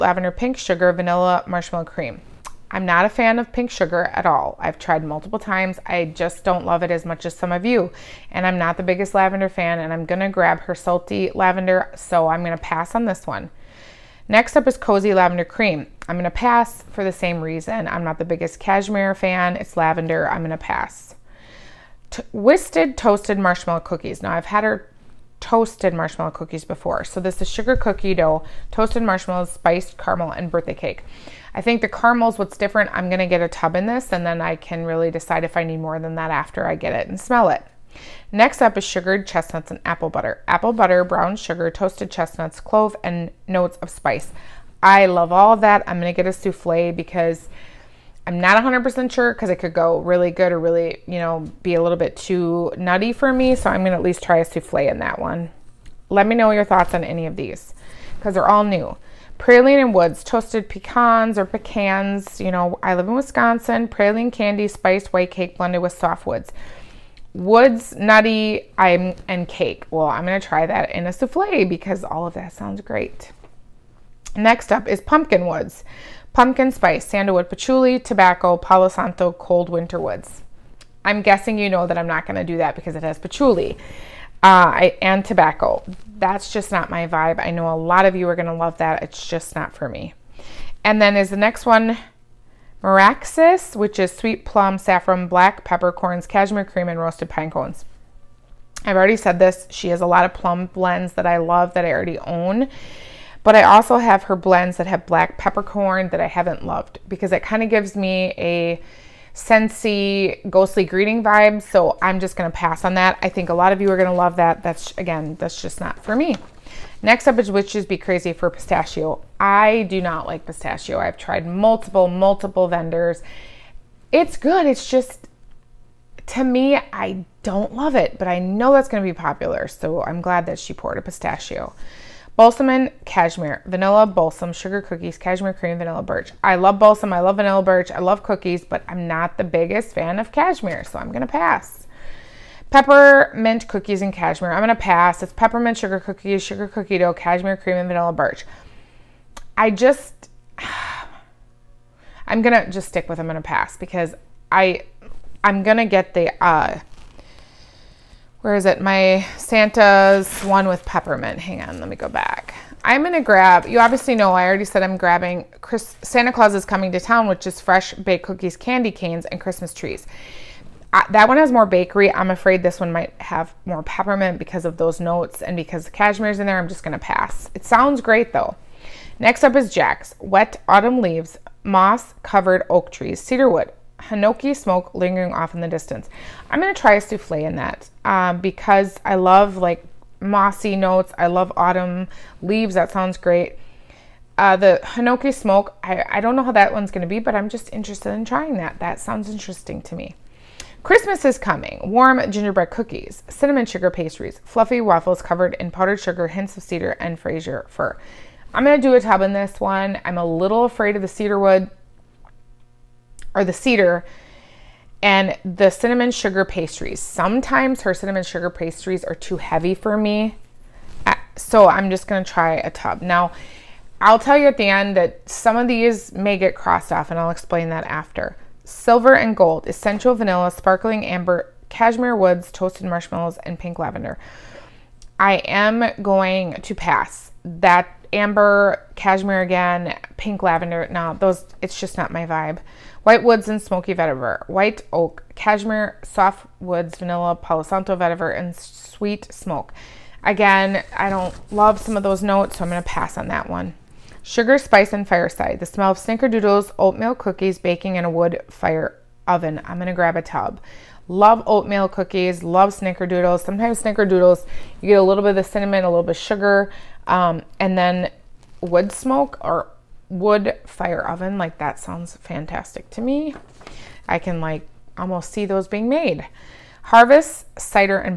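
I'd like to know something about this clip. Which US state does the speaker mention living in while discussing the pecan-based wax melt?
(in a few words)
Wisconsin.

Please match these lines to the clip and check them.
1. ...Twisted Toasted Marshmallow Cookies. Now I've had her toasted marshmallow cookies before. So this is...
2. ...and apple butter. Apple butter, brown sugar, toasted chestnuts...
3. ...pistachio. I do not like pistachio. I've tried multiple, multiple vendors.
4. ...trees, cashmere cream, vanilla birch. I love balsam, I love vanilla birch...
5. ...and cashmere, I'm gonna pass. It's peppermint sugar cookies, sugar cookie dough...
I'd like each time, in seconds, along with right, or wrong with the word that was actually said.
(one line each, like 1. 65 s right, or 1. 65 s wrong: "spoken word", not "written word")
1. 22 s right
2. 39 s right
3. 118 s right
4. 134 s wrong: "cookies", not "trees"
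5. 144 s right.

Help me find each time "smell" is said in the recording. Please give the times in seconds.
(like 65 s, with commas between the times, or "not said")
37 s, 255 s.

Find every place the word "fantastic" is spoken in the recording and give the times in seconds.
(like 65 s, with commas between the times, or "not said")
272 s.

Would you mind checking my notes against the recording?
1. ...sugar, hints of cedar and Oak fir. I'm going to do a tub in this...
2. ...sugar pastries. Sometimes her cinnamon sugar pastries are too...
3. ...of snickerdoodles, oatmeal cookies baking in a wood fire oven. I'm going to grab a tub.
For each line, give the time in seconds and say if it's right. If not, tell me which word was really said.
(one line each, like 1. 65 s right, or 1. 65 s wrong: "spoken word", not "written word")
1. 205 s wrong: "Fraser", not "Oak"
2. 216 s right
3. 255 s right.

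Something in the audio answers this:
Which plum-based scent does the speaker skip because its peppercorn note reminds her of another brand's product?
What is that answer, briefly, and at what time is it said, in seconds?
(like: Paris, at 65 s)
Meraxes, at 92 s.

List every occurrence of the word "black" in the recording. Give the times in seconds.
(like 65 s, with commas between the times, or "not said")
95 s, 105 s.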